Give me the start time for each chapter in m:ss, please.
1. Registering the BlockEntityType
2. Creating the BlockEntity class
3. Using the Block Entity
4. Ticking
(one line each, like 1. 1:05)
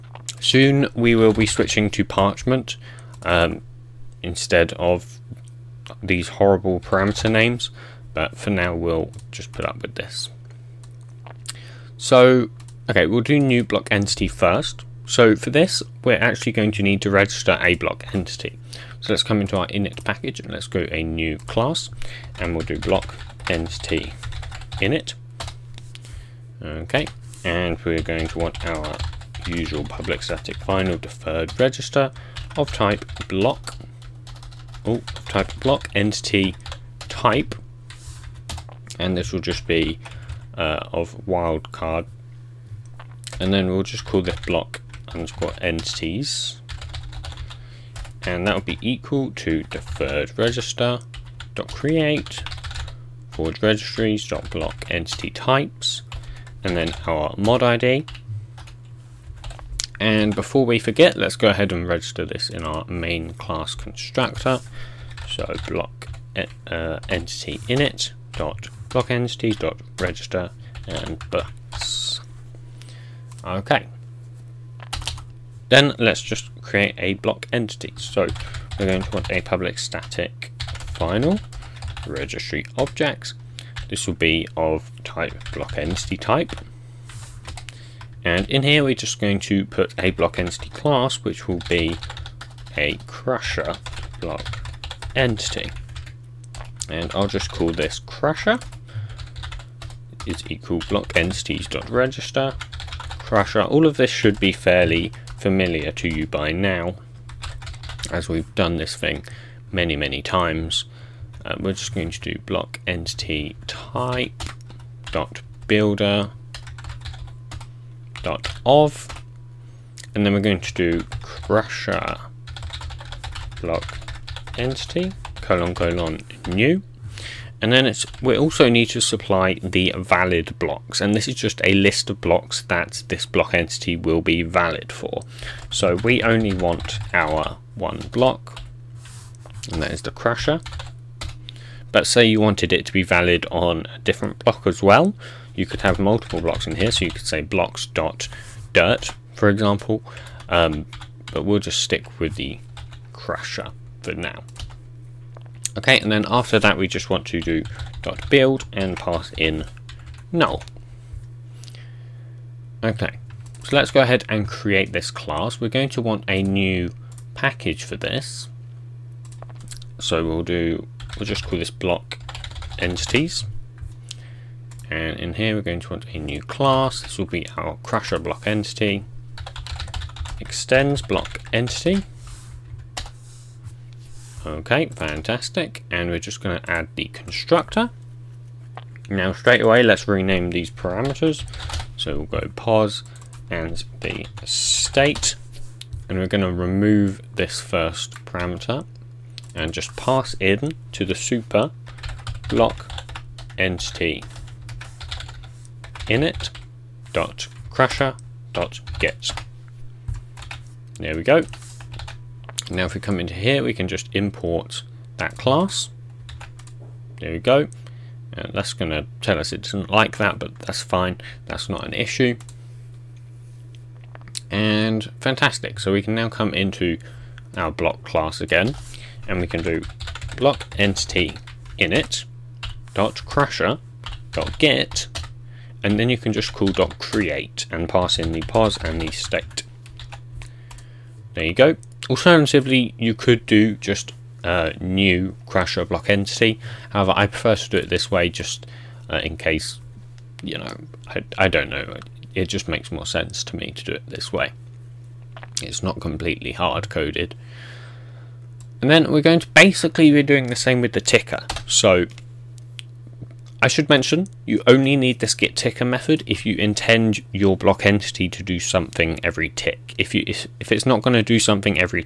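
1. 0:21
2. 2:56
3. 3:46
4. 4:16.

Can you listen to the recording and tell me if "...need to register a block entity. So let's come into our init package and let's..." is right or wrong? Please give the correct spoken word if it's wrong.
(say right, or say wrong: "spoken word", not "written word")
right.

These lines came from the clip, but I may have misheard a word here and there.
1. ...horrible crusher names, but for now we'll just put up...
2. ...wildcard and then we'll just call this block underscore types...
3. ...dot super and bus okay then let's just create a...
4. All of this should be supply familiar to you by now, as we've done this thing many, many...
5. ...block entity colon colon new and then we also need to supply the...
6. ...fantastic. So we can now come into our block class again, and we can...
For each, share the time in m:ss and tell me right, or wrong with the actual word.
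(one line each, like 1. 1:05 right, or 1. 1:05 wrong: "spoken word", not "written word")
1. 0:06 wrong: "parameter", not "crusher"
2. 0:41 wrong: "entities", not "types"
3. 1:09 wrong: "register", not "super"
4. 1:43 wrong: "fairly", not "supply"
5. 2:03 right
6. 3:45 right.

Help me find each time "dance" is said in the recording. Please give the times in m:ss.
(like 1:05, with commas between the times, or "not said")
not said.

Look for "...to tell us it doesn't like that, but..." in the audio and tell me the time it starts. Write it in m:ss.
3:38.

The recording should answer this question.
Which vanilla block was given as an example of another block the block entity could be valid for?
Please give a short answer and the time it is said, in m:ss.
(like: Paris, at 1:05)
dirt, at 2:27.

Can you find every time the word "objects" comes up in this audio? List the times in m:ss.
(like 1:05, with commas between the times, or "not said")
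1:22.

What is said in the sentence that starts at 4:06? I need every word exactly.
However, I prefer to do it this way just uh, in case, you know, I, I don't know.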